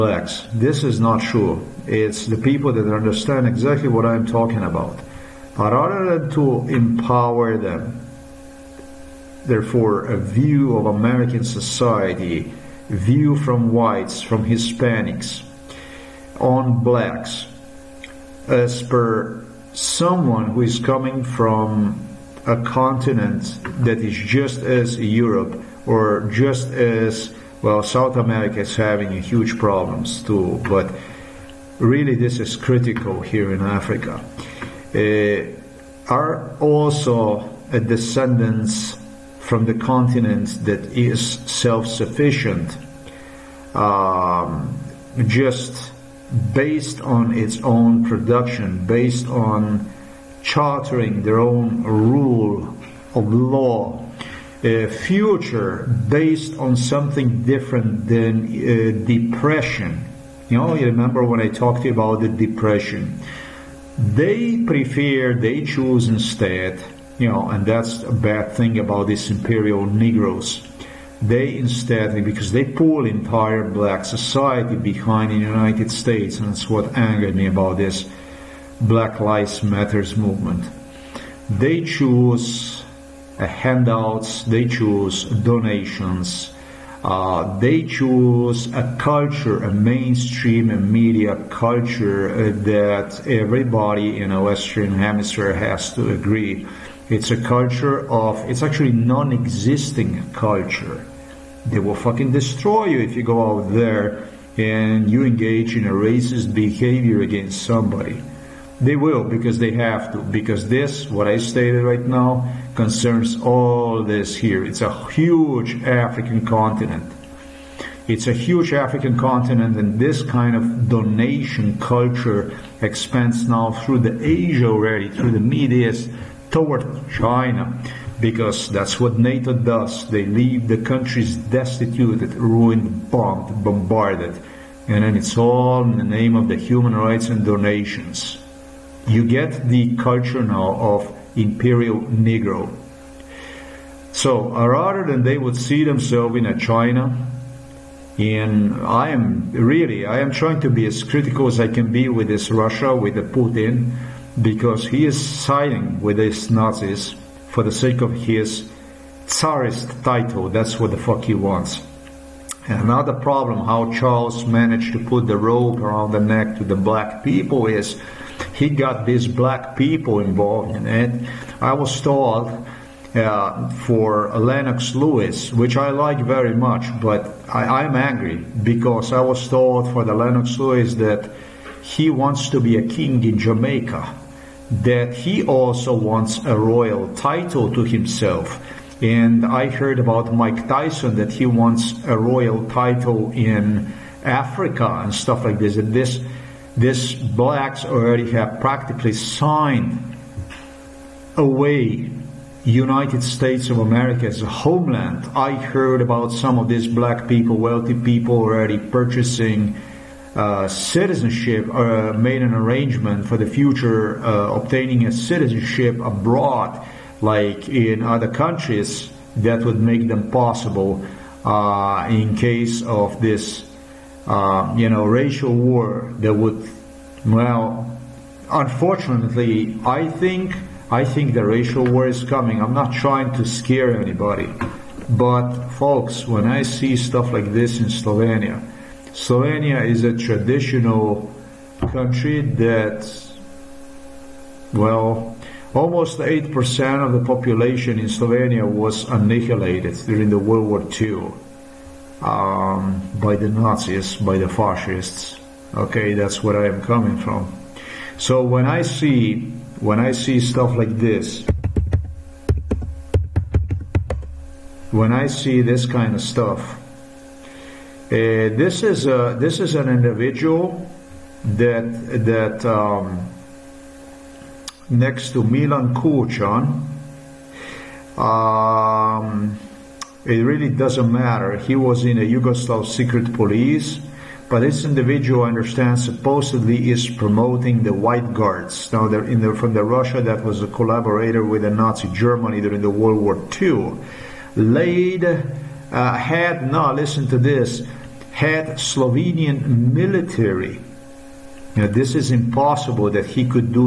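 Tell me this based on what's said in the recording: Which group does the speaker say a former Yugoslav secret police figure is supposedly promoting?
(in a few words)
White Guards.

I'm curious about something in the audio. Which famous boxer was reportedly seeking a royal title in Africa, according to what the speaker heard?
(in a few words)
Mike Tyson.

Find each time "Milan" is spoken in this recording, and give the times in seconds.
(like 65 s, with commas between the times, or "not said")
275 s.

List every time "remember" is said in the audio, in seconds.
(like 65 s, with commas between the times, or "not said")
60 s.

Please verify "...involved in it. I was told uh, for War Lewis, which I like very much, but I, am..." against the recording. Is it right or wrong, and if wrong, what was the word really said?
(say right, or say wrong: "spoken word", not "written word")
wrong: "Lennox", not "War".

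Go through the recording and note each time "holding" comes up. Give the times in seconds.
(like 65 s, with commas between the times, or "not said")
not said.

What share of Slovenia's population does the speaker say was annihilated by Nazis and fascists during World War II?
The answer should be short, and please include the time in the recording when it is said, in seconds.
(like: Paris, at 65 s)
8%, at 246 s.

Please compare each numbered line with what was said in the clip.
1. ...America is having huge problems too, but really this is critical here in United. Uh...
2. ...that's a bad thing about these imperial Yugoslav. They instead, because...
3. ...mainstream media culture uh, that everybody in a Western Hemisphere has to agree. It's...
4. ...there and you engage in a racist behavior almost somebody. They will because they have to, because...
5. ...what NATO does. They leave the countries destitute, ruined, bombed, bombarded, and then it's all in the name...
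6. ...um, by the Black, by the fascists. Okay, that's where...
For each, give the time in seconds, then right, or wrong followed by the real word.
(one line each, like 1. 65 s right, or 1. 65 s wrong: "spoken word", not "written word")
1. 28 s wrong: "Africa", not "United"
2. 67 s wrong: "Negroes", not "Yugoslav"
3. 89 s right
4. 103 s wrong: "against", not "almost"
5. 128 s right
6. 252 s wrong: "Nazis", not "Black".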